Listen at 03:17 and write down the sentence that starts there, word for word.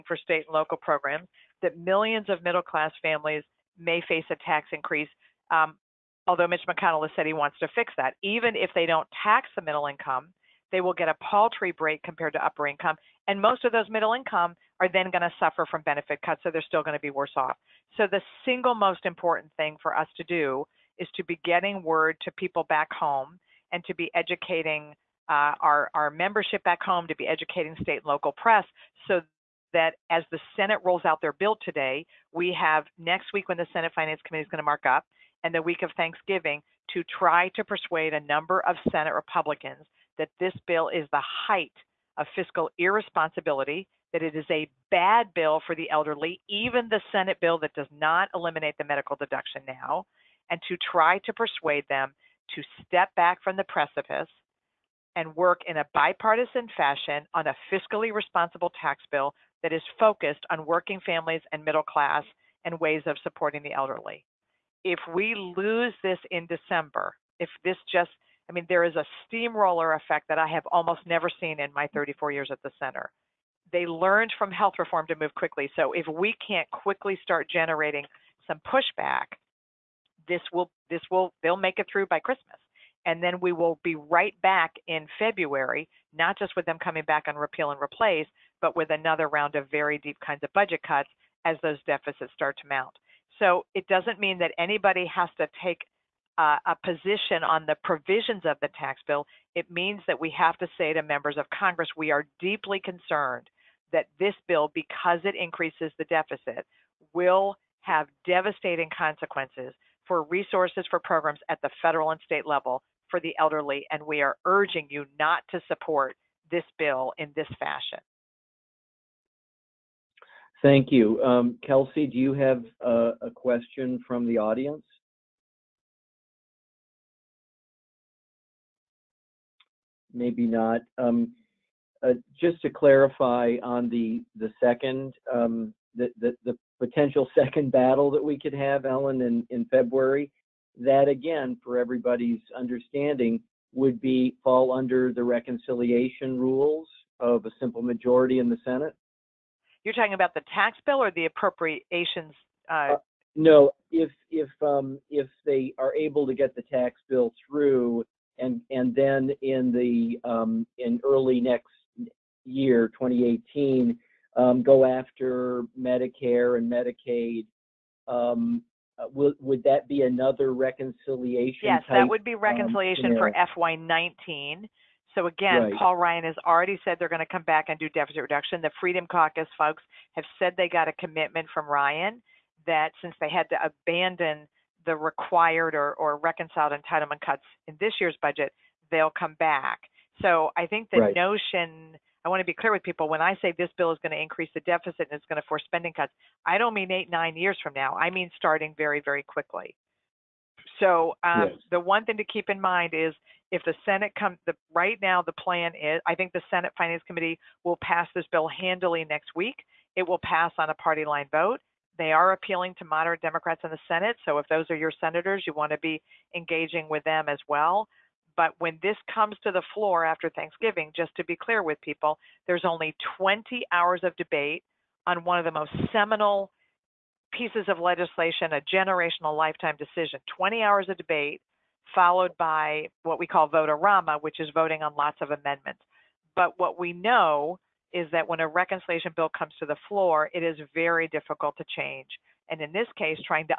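I mean starting very, very quickly.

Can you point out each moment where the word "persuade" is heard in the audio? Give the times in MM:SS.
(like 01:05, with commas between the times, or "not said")
00:37, 00:51.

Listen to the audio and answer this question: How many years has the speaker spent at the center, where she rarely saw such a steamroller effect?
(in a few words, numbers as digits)
34 years.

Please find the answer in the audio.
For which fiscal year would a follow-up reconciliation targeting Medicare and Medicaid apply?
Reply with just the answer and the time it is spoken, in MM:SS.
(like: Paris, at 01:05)
FY19, at 02:53.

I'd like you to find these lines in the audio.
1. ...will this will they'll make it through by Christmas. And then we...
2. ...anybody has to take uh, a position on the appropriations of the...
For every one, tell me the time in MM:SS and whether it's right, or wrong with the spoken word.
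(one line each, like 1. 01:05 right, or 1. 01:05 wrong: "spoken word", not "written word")
1. 01:20 right
2. 01:34 wrong: "provisions", not "appropriations".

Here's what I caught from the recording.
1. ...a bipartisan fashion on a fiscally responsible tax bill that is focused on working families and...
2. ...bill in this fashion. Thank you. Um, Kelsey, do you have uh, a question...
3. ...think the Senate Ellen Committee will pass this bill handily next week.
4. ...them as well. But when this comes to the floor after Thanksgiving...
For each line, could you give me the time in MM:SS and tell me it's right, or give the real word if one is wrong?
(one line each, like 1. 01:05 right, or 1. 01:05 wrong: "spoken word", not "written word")
1. 00:55 right
2. 01:56 right
3. 03:26 wrong: "Finance", not "Ellen"
4. 03:37 right.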